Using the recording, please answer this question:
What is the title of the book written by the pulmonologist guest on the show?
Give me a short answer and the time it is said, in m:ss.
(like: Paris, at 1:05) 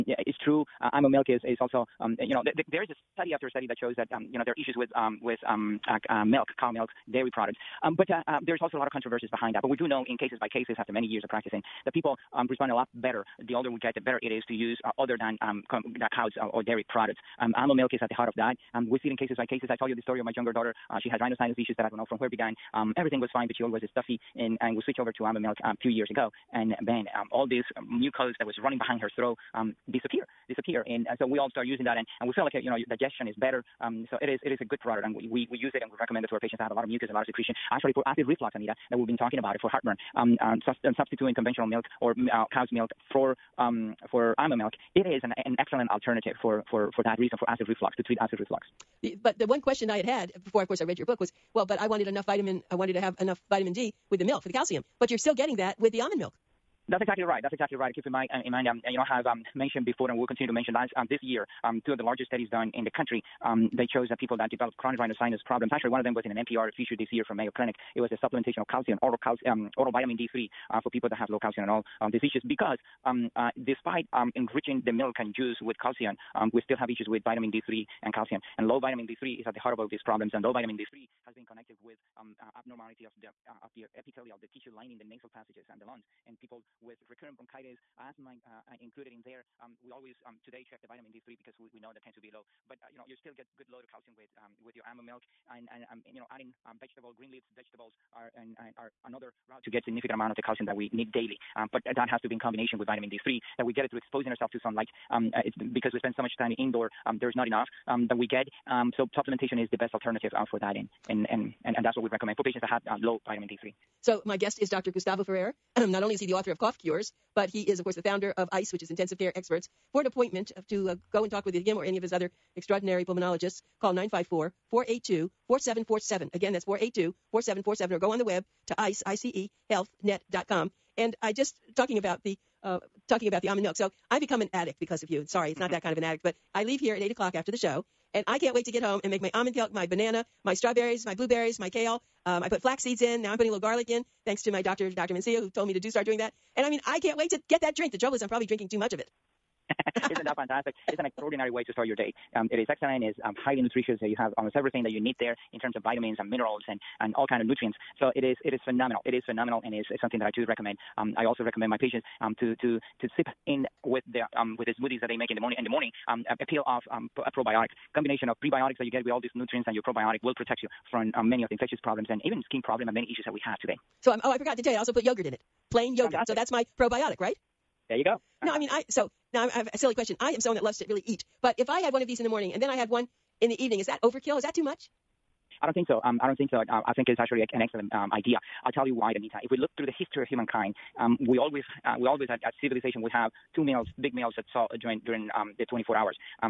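Cough Cures, at 1:56.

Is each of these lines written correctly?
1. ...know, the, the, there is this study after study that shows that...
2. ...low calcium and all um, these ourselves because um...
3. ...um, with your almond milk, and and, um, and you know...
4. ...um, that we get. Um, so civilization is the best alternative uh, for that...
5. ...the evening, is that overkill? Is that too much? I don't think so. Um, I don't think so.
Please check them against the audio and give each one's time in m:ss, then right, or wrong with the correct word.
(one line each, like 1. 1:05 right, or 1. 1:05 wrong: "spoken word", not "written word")
1. 0:02 right
2. 1:11 wrong: "issues", not "ourselves"
3. 1:34 right
4. 1:47 wrong: "supplementation", not "civilization"
5. 3:03 right.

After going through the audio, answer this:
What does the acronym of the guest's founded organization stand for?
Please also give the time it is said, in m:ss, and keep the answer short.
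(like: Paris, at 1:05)
Intensive Care Experts, at 1:58.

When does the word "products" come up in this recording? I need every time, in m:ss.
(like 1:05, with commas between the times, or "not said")
0:07, 0:16, 0:34.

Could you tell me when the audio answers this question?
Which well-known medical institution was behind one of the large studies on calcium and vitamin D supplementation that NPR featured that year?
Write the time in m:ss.
1:07.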